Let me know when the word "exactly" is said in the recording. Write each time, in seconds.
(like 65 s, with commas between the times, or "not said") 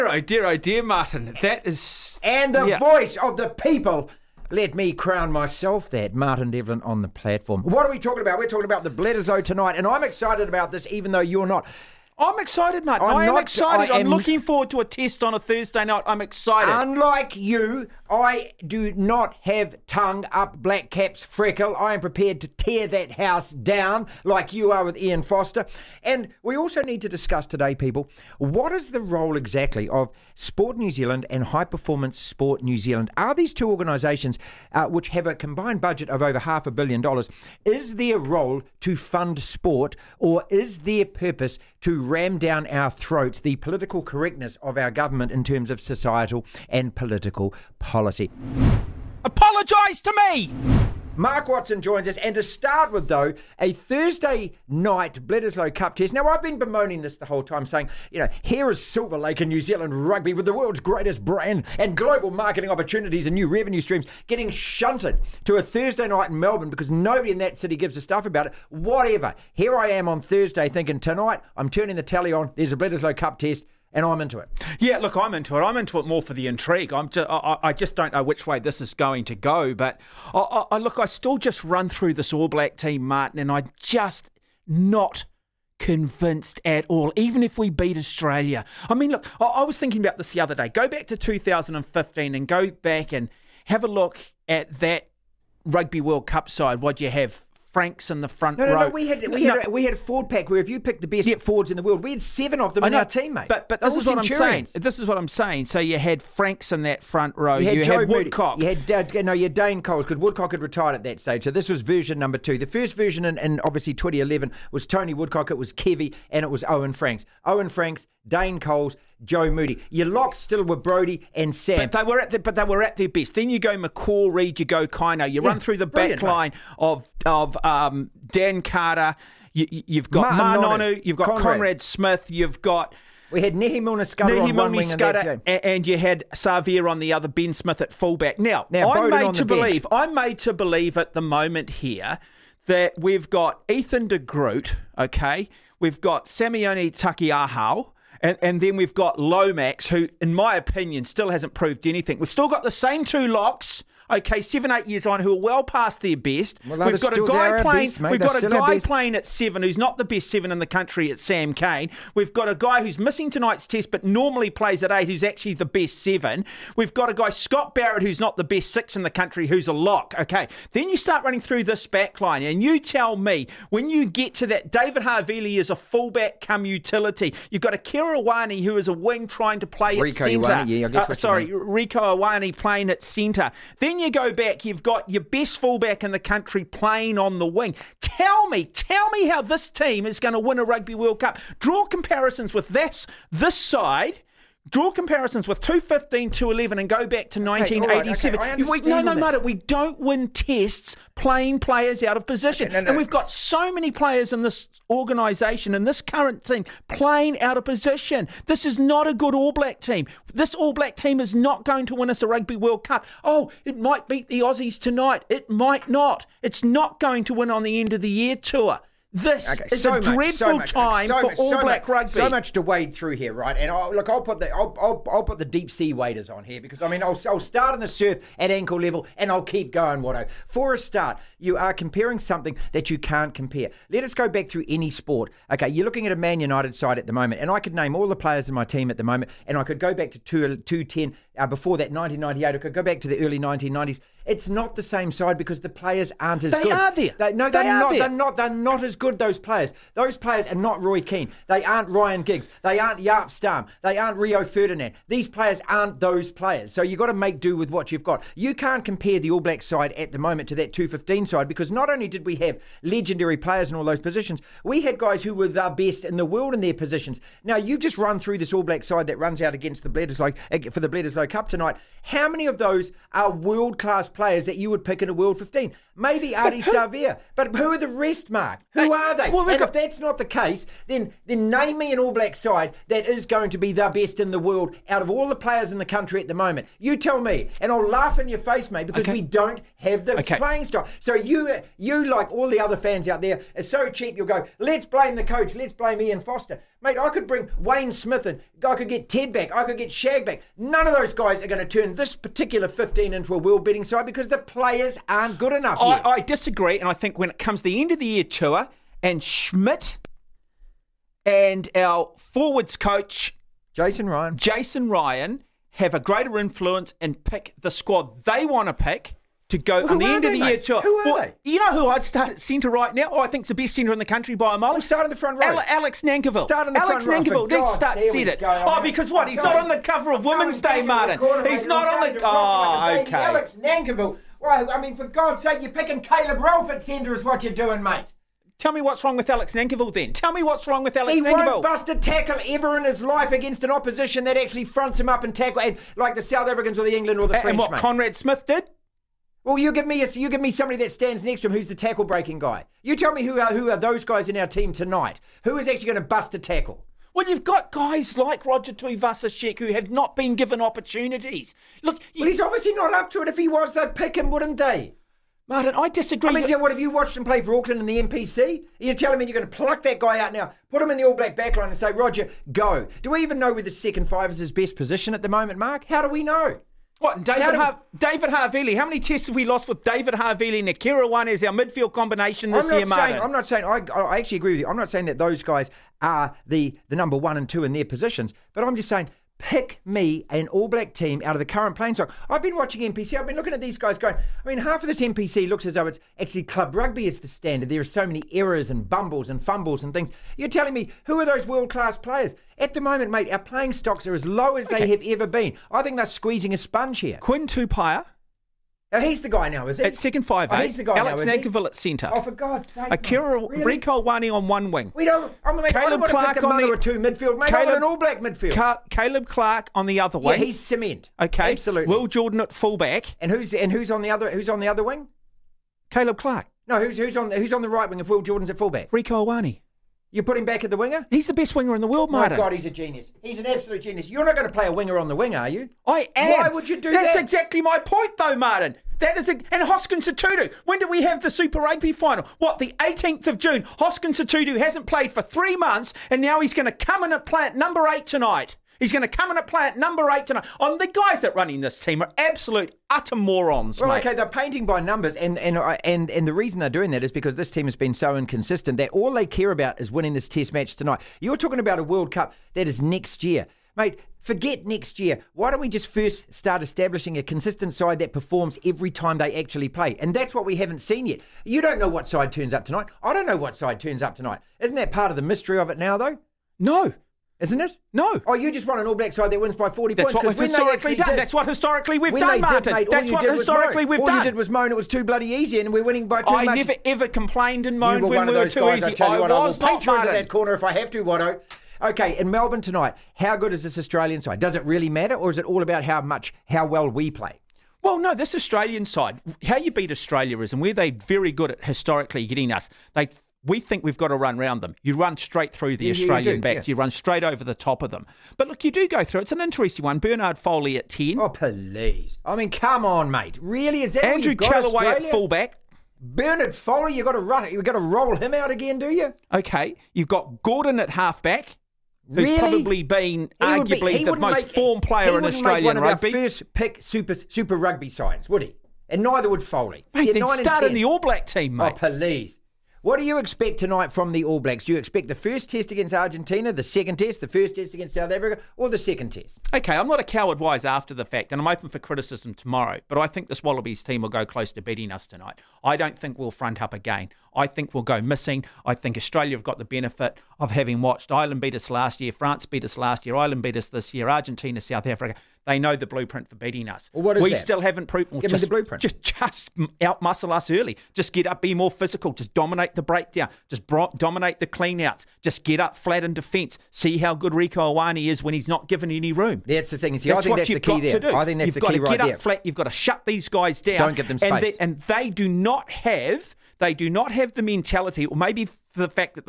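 29 s, 437 s.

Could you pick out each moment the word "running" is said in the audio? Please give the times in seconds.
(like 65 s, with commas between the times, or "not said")
171 s, 451 s.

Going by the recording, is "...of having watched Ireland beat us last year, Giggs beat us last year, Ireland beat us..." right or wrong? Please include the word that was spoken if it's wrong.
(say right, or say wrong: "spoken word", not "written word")
wrong: "France", not "Giggs".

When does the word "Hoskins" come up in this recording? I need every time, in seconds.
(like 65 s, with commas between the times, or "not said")
439 s, 443 s.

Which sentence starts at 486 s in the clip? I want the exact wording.
I never ever complained and moaned when we were too guys, easy.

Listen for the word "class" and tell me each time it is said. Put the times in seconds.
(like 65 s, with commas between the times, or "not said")
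273 s, 401 s.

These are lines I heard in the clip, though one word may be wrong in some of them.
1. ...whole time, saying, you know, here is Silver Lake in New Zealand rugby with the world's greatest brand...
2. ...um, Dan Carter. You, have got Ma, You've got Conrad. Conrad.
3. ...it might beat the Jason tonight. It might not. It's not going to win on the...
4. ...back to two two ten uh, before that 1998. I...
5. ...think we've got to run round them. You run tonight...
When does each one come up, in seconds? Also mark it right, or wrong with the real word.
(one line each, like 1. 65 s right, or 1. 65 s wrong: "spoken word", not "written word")
1. 57 s right
2. 127 s right
3. 213 s wrong: "Aussies", not "Jason"
4. 239 s right
5. 503 s wrong: "straight", not "tonight".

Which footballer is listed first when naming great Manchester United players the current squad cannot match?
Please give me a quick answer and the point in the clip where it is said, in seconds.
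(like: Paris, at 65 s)
Roy Keane, at 250 s.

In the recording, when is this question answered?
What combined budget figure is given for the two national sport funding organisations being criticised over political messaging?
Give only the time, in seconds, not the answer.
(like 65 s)
36 s.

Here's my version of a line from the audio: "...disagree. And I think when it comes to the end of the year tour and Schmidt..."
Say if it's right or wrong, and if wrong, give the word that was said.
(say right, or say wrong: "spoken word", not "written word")
right.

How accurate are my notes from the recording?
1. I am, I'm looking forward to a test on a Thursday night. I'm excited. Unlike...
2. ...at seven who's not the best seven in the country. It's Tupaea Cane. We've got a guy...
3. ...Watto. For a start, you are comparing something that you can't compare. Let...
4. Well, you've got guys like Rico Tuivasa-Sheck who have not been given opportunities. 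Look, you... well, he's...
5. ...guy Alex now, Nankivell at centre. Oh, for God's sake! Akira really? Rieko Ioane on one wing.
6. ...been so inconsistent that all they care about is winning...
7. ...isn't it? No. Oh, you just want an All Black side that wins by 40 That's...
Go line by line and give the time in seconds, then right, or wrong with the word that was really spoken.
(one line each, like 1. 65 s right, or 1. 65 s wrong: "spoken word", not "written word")
1. 13 s right
2. 159 s wrong: "Sam", not "Tupaea"
3. 230 s right
4. 357 s wrong: "Roger", not "Rico"
5. 410 s right
6. 457 s right
7. 477 s right.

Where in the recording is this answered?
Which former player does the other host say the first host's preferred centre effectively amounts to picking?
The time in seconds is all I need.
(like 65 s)
335 s.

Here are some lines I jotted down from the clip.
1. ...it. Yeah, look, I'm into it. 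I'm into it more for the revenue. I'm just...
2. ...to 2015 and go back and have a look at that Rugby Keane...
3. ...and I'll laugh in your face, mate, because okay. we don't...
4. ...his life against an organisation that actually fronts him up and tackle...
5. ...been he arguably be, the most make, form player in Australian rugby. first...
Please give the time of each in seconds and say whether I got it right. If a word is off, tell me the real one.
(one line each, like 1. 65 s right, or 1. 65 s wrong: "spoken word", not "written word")
1. 74 s wrong: "intrigue", not "revenue"
2. 91 s wrong: "World", not "Keane"
3. 287 s right
4. 342 s wrong: "opposition", not "organisation"
5. 522 s right.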